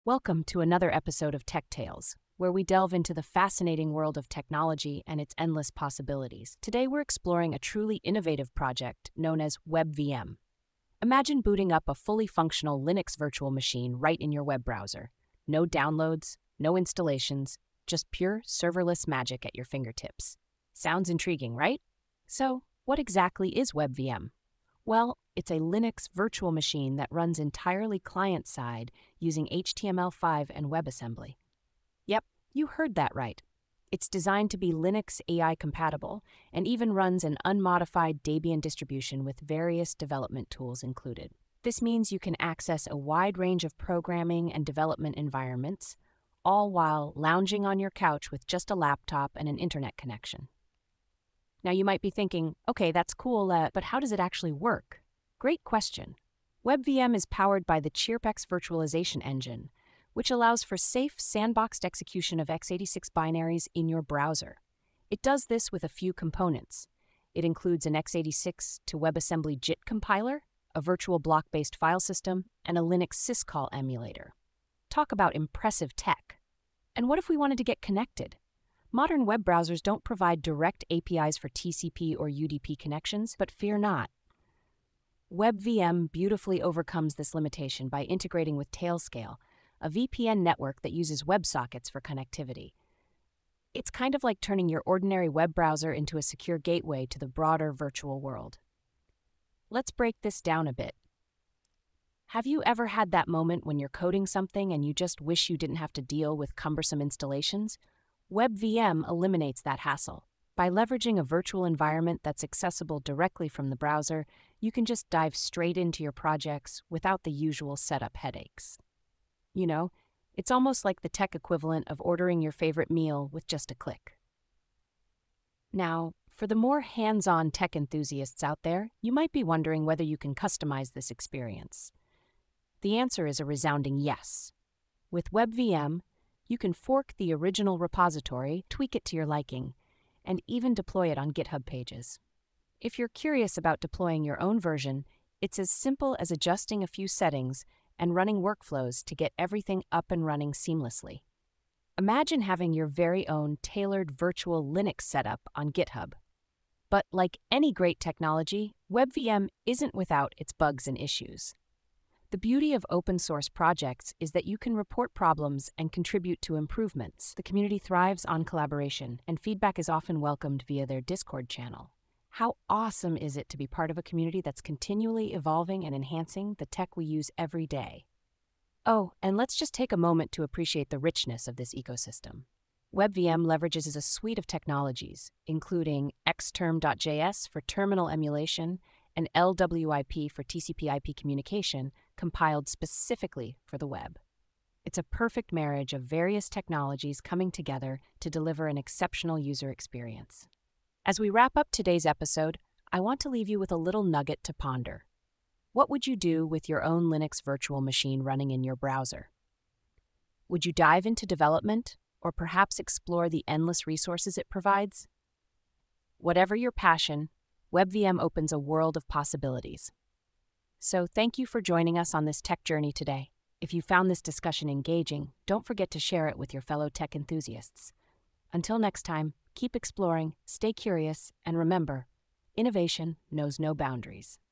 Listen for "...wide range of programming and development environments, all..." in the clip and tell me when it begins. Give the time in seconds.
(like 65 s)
42 s.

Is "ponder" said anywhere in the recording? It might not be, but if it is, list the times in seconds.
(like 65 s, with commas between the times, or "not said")
204 s.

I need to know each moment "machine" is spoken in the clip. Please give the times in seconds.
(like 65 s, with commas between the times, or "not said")
13 s, 26 s, 207 s.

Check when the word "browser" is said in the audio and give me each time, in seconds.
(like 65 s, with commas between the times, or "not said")
14 s, 64 s, 79 s, 95 s, 113 s, 208 s.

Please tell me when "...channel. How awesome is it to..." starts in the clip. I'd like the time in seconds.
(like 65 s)
171 s.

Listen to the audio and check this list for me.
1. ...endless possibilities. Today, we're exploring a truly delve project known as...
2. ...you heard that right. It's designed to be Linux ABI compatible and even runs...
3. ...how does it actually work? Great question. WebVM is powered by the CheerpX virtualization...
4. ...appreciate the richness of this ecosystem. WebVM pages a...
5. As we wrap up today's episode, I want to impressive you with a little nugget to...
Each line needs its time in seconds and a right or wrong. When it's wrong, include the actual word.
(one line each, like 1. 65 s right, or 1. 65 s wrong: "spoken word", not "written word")
1. 5 s wrong: "innovative", not "delve"
2. 32 s right
3. 53 s right
4. 180 s wrong: "leverages", not "pages"
5. 201 s wrong: "leave", not "impressive".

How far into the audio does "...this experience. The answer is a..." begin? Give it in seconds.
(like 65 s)
130 s.